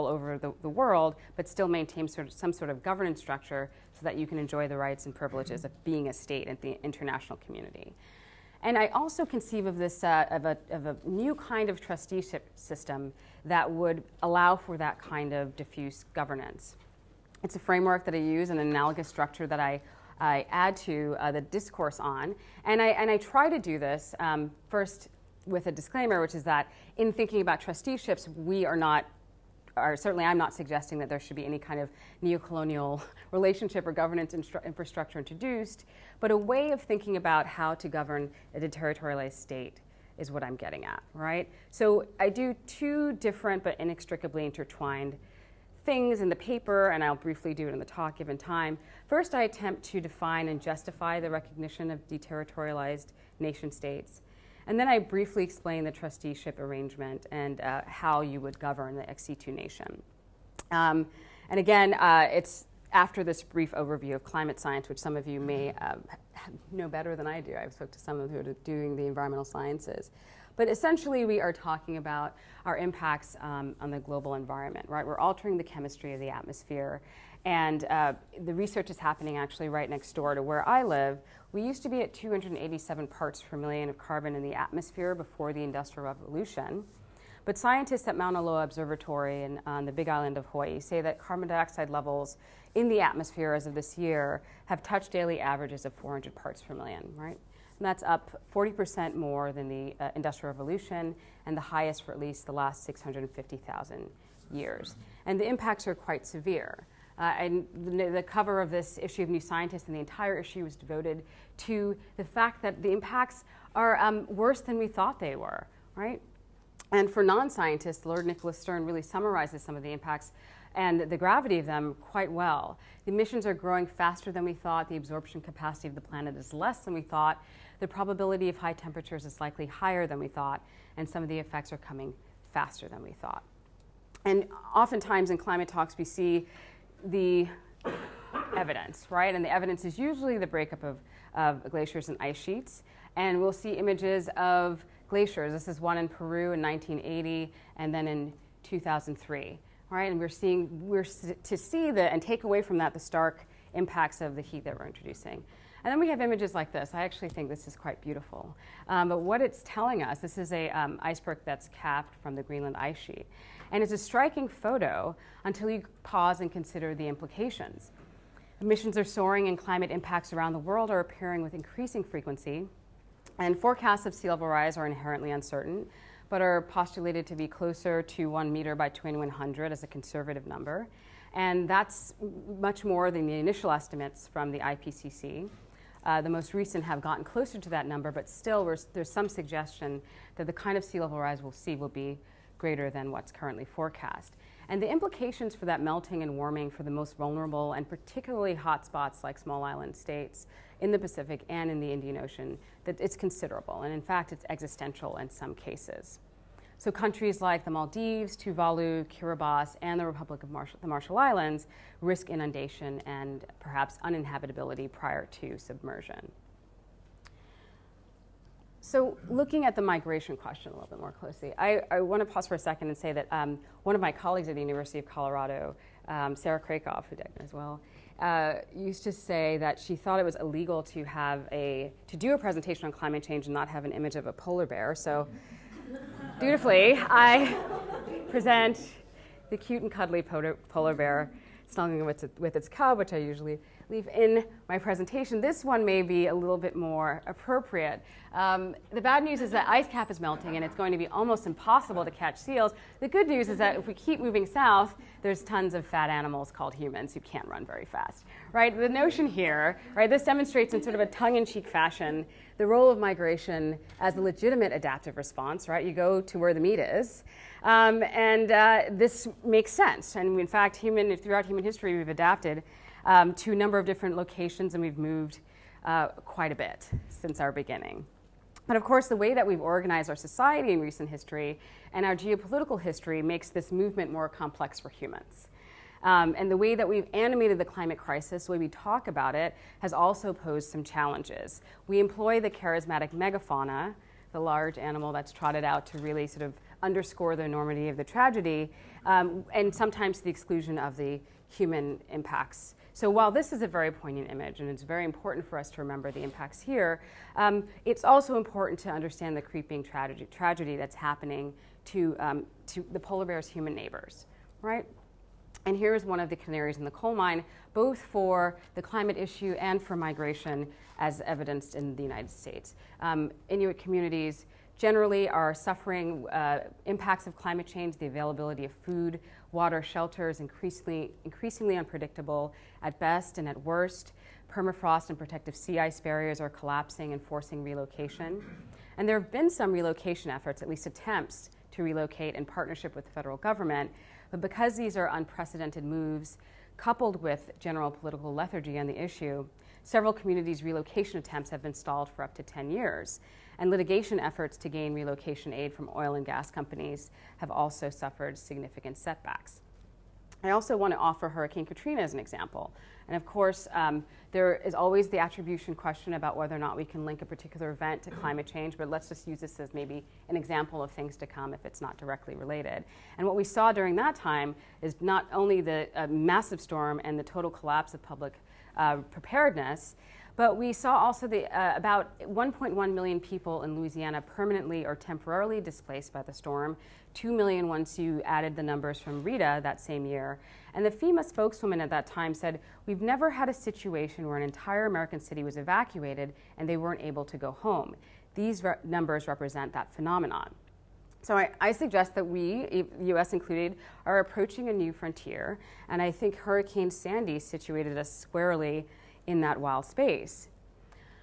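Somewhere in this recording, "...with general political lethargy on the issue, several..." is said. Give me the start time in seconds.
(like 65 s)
347 s.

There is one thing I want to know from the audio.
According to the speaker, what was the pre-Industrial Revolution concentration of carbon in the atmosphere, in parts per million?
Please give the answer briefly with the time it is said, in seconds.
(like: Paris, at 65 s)
287, at 82 s.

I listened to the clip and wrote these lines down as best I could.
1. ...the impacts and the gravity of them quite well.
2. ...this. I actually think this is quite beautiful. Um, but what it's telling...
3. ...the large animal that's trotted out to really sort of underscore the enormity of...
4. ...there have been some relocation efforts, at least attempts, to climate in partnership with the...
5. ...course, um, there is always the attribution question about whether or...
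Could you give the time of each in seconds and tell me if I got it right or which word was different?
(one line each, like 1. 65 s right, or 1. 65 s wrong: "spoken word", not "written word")
1. 119 s right
2. 156 s right
3. 294 s right
4. 339 s wrong: "relocate", not "climate"
5. 363 s right.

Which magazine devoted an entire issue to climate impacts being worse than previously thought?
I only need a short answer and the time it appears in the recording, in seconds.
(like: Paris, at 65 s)
New Scientist, at 109 s.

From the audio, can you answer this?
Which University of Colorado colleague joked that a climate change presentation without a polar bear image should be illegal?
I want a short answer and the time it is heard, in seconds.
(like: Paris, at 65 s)
Sarah Krakoff, at 226 s.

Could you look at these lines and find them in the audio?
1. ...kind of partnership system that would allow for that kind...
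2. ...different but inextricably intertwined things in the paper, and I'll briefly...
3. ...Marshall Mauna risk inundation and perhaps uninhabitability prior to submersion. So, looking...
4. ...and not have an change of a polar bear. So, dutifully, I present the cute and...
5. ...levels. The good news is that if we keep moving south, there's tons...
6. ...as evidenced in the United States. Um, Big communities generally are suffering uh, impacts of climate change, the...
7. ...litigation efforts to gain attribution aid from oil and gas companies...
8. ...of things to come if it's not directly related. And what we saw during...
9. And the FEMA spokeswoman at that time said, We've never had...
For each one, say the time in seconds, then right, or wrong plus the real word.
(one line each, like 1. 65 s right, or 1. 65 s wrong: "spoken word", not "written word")
1. 11 s wrong: "trusteeship", not "partnership"
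2. 43 s right
3. 210 s wrong: "Islands", not "Mauna"
4. 233 s wrong: "image", not "change"
5. 252 s wrong: "seals", not "levels"
6. 320 s wrong: "Inuit", not "Big"
7. 353 s wrong: "relocation", not "attribution"
8. 370 s right
9. 390 s right.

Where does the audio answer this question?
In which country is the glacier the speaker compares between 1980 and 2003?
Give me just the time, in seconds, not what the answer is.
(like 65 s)
146 s.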